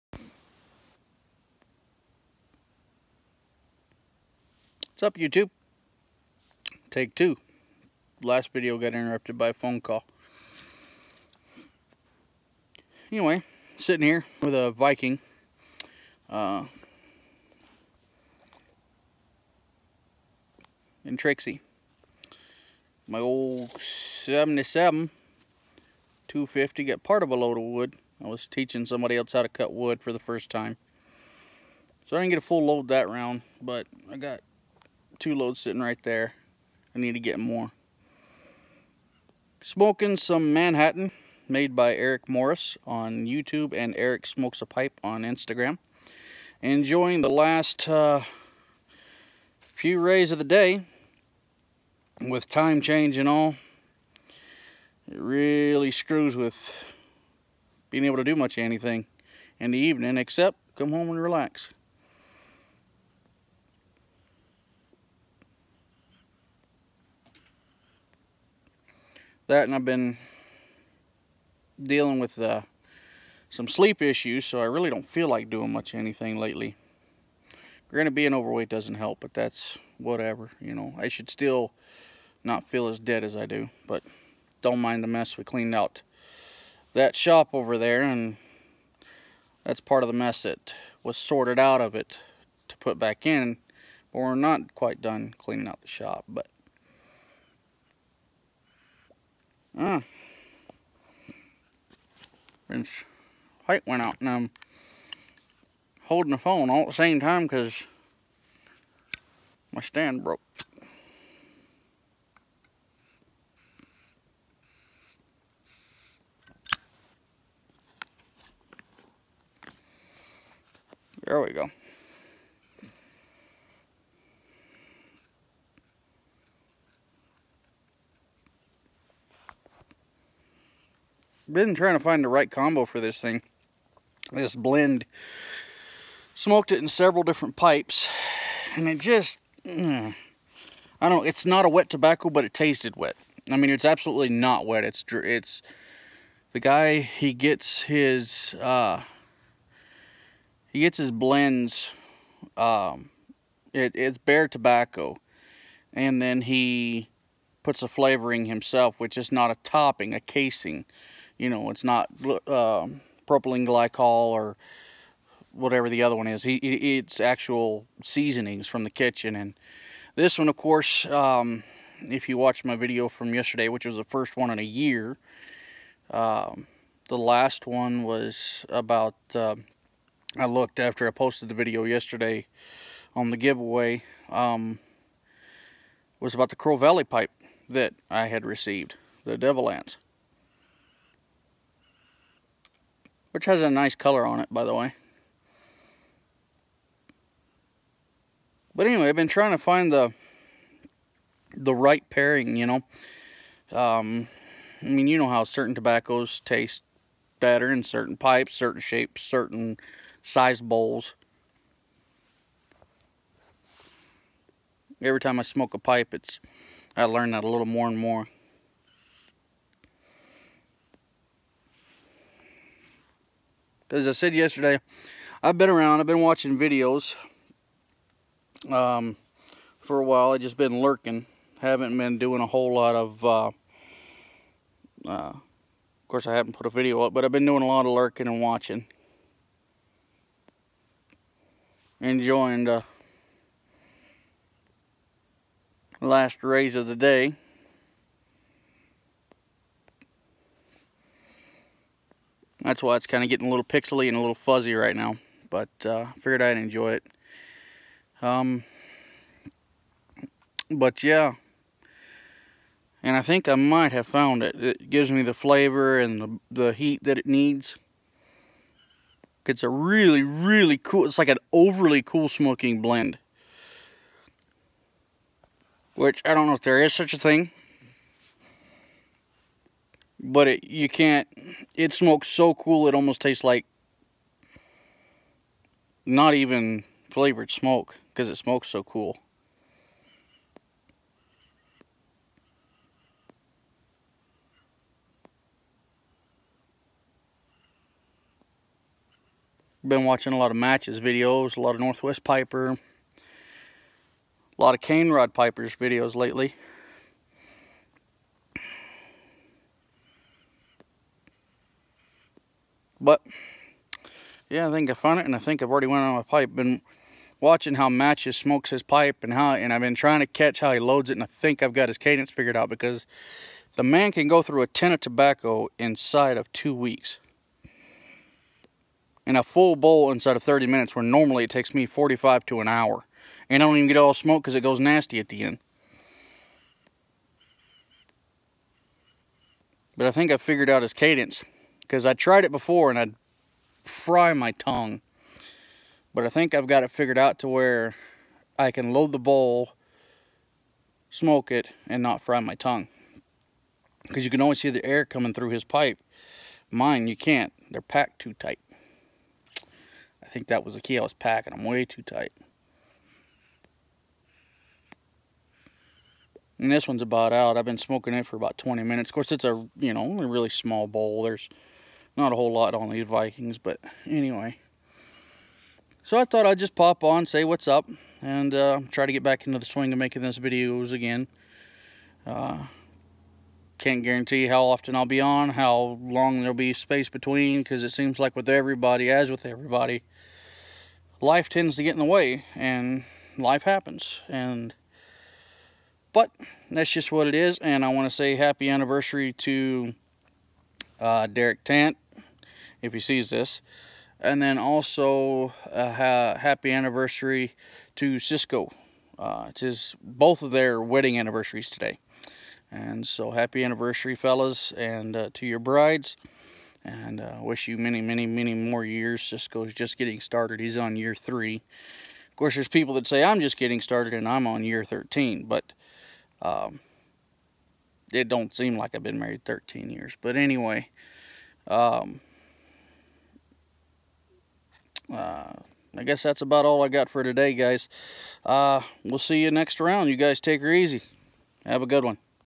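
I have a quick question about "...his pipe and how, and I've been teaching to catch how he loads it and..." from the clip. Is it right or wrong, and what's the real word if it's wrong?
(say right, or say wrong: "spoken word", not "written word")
wrong: "trying", not "teaching".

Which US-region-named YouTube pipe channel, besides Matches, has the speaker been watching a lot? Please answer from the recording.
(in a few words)
Northwest Piper.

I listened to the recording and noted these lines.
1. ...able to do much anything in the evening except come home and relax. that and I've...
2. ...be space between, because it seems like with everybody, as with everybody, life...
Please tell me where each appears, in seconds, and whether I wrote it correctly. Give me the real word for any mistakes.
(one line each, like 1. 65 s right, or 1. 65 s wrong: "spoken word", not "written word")
1. 58 s right
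2. 386 s right.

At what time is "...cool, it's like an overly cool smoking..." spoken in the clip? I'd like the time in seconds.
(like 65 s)
270 s.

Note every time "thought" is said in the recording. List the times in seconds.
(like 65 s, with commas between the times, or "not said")
376 s.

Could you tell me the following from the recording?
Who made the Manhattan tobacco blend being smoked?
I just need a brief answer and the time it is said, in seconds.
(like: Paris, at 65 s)
Erik Morris, at 41 s.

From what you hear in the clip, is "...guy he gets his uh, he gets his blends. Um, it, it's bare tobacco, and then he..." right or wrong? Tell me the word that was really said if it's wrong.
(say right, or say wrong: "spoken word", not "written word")
right.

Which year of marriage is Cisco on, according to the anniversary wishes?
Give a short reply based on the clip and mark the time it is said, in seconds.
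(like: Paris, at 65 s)
3, at 420 s.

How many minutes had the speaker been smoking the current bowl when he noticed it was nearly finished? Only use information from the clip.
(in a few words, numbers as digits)
20.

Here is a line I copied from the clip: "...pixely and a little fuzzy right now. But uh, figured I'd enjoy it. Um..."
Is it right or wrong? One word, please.
right.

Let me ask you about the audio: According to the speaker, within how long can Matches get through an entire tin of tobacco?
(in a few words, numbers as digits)
two weeks.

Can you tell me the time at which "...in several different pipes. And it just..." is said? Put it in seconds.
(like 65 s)
136 s.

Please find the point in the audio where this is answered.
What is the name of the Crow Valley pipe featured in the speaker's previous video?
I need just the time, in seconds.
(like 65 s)
189 s.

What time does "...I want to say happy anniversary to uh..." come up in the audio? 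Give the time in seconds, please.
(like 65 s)
397 s.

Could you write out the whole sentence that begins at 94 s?
But we're not quite done cleaning out the shop, but Yeah.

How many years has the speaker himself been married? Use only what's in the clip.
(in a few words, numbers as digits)
13.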